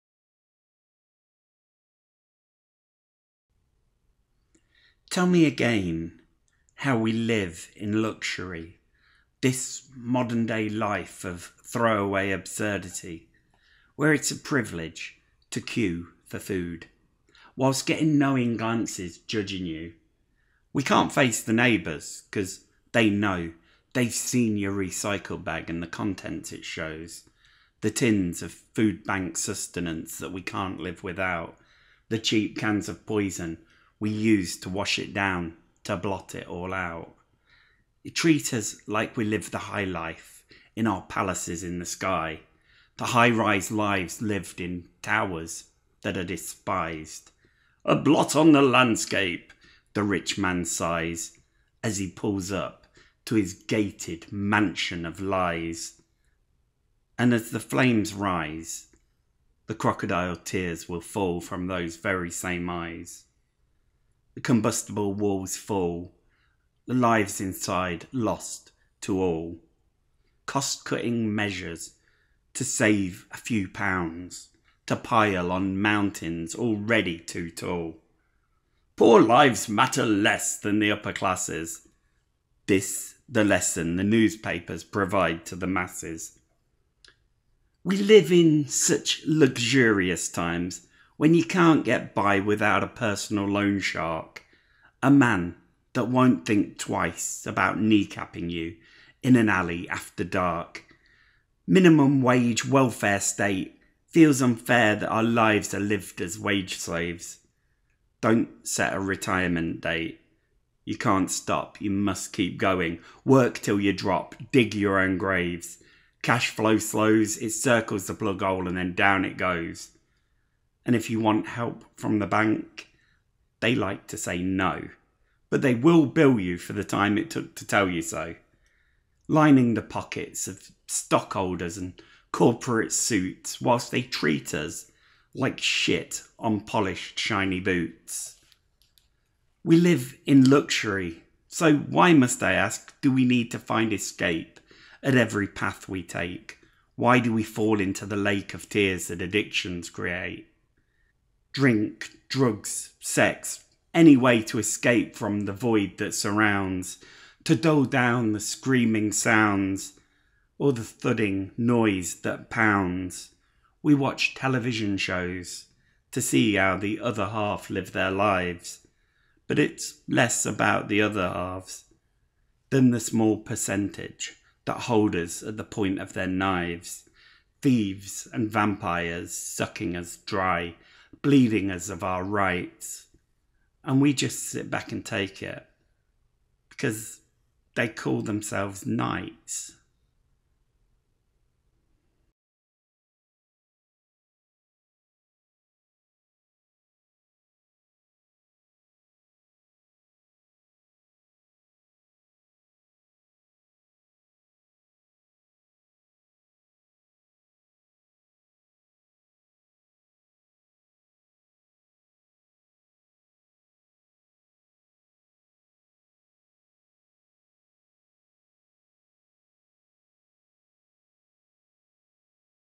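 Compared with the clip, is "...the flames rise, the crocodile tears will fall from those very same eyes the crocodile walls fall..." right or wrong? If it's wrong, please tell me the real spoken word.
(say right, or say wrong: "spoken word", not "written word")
wrong: "combustible", not "crocodile".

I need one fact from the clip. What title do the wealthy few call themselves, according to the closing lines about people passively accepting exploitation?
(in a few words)
knights.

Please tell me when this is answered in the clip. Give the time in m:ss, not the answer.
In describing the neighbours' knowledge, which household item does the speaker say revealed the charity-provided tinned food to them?
0:24.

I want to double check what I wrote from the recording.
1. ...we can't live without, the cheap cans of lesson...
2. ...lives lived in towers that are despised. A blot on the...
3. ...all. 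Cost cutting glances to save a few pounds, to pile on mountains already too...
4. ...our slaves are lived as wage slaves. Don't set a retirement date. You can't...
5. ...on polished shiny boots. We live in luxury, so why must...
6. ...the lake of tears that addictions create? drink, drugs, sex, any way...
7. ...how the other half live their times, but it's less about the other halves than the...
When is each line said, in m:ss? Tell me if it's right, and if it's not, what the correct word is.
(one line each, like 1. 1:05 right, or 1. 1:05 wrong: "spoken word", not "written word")
1. 0:30 wrong: "poison", not "lesson"
2. 0:43 right
3. 1:09 wrong: "measures", not "glances"
4. 1:45 wrong: "lives", not "slaves"
5. 2:16 right
6. 2:28 right
7. 2:46 wrong: "lives", not "times".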